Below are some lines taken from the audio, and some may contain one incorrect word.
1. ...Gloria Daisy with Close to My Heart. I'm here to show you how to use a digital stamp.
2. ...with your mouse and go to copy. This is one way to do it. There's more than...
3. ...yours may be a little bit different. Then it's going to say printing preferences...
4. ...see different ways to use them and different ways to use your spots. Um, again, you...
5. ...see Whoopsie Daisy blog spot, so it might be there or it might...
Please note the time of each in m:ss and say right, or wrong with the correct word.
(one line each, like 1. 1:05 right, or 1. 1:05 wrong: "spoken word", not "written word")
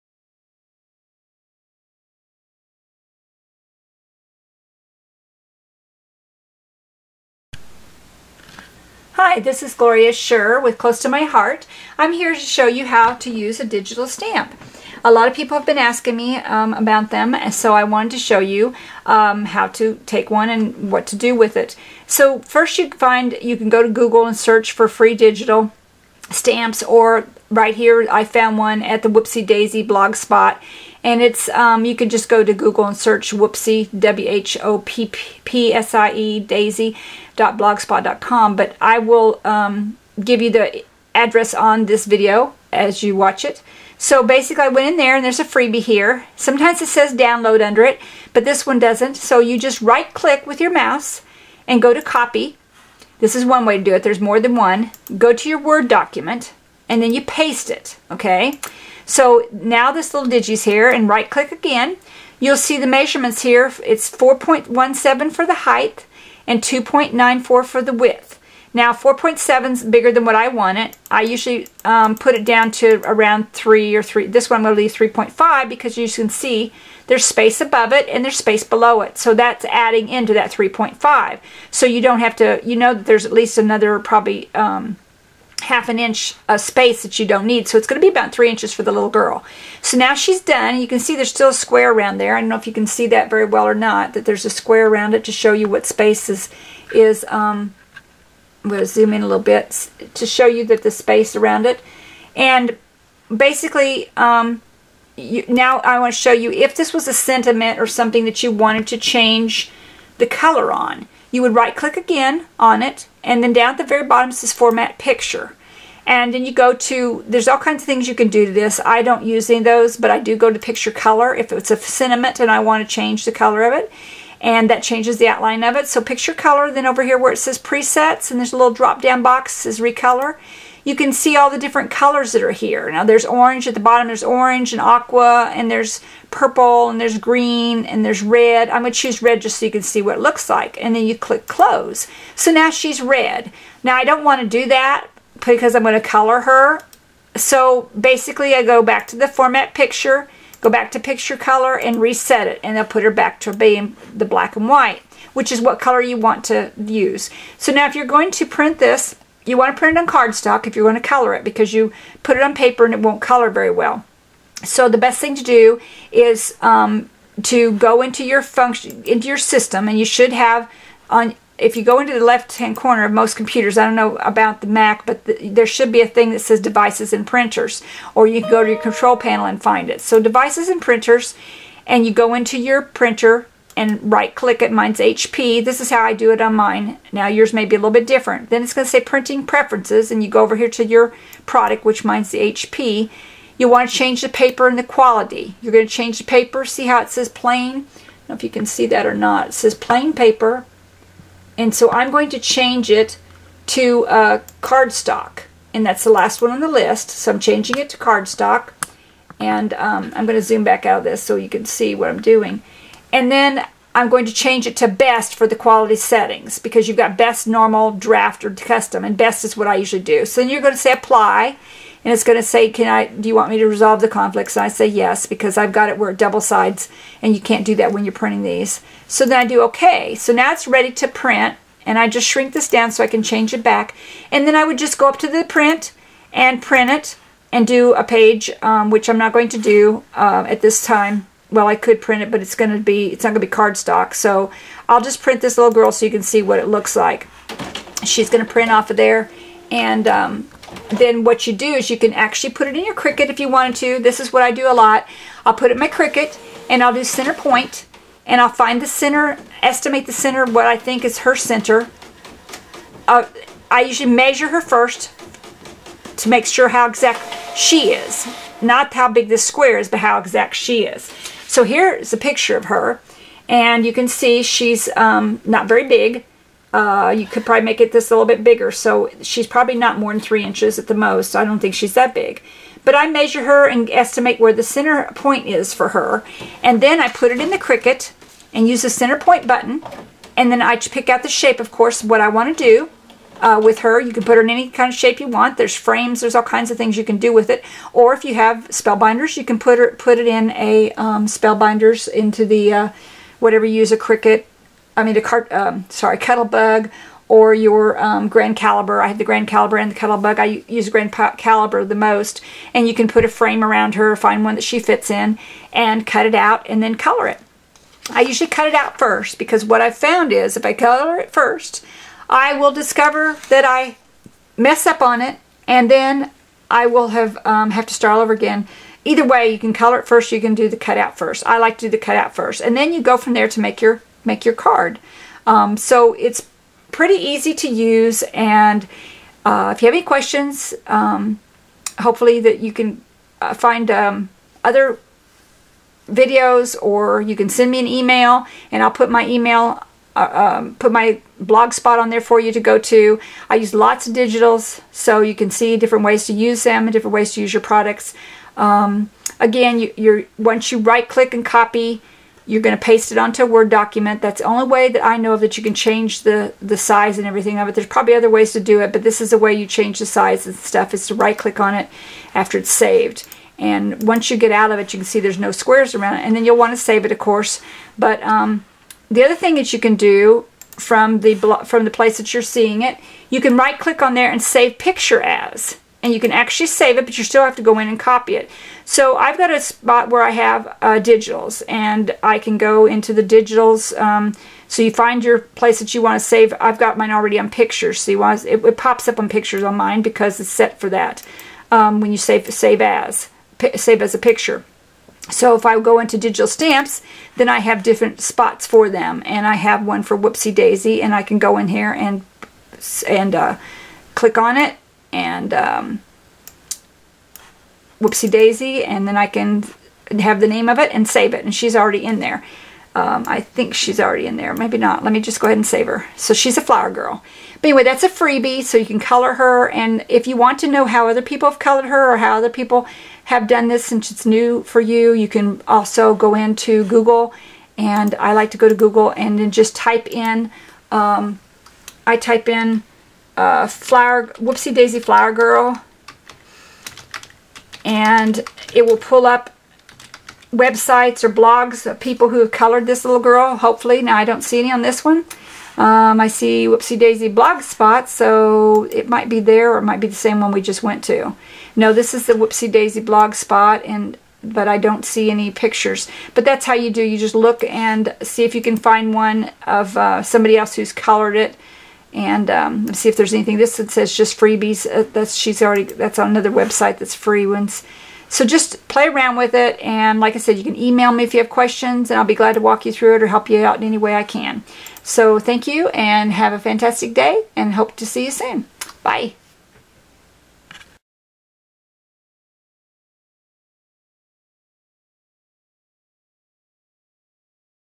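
1. 0:09 wrong: "Shirr", not "Daisy"
2. 0:50 right
3. 3:07 right
4. 5:55 wrong: "products", not "spots"
5. 7:36 right.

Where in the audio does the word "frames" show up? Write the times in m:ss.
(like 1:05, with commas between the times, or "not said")
4:55, 5:13.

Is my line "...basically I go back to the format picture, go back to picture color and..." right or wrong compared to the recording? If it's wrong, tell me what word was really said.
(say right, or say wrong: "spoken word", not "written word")
right.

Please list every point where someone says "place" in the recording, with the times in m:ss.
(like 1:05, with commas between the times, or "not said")
6:21, 6:35.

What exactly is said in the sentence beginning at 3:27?
So I'm changing it to cardstock.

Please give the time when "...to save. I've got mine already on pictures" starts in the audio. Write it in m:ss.
6:36.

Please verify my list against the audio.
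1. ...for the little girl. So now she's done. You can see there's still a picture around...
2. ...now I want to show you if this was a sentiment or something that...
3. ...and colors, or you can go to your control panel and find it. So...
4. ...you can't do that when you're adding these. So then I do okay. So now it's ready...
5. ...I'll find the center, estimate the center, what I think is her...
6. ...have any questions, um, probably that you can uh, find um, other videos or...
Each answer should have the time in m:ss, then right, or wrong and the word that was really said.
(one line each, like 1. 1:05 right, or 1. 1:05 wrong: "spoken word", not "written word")
1. 1:28 wrong: "square", not "picture"
2. 1:45 right
3. 2:57 wrong: "printers", not "colors"
4. 3:47 wrong: "printing", not "adding"
5. 4:18 right
6. 5:39 wrong: "hopefully", not "probably".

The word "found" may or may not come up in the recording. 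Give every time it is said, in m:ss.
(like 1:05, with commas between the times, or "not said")
0:28, 5:19.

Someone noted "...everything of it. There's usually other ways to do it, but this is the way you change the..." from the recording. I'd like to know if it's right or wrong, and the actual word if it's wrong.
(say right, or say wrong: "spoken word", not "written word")
wrong: "probably", not "usually".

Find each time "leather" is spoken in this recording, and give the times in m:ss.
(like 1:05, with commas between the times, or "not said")
not said.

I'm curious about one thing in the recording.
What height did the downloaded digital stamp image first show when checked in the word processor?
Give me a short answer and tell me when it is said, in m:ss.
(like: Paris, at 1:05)
4.17, at 1:04.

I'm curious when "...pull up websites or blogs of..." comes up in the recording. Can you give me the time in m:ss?
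7:28.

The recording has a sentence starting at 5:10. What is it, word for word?
I use Grand Calibur the most.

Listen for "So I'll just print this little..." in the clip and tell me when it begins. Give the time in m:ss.
4:04.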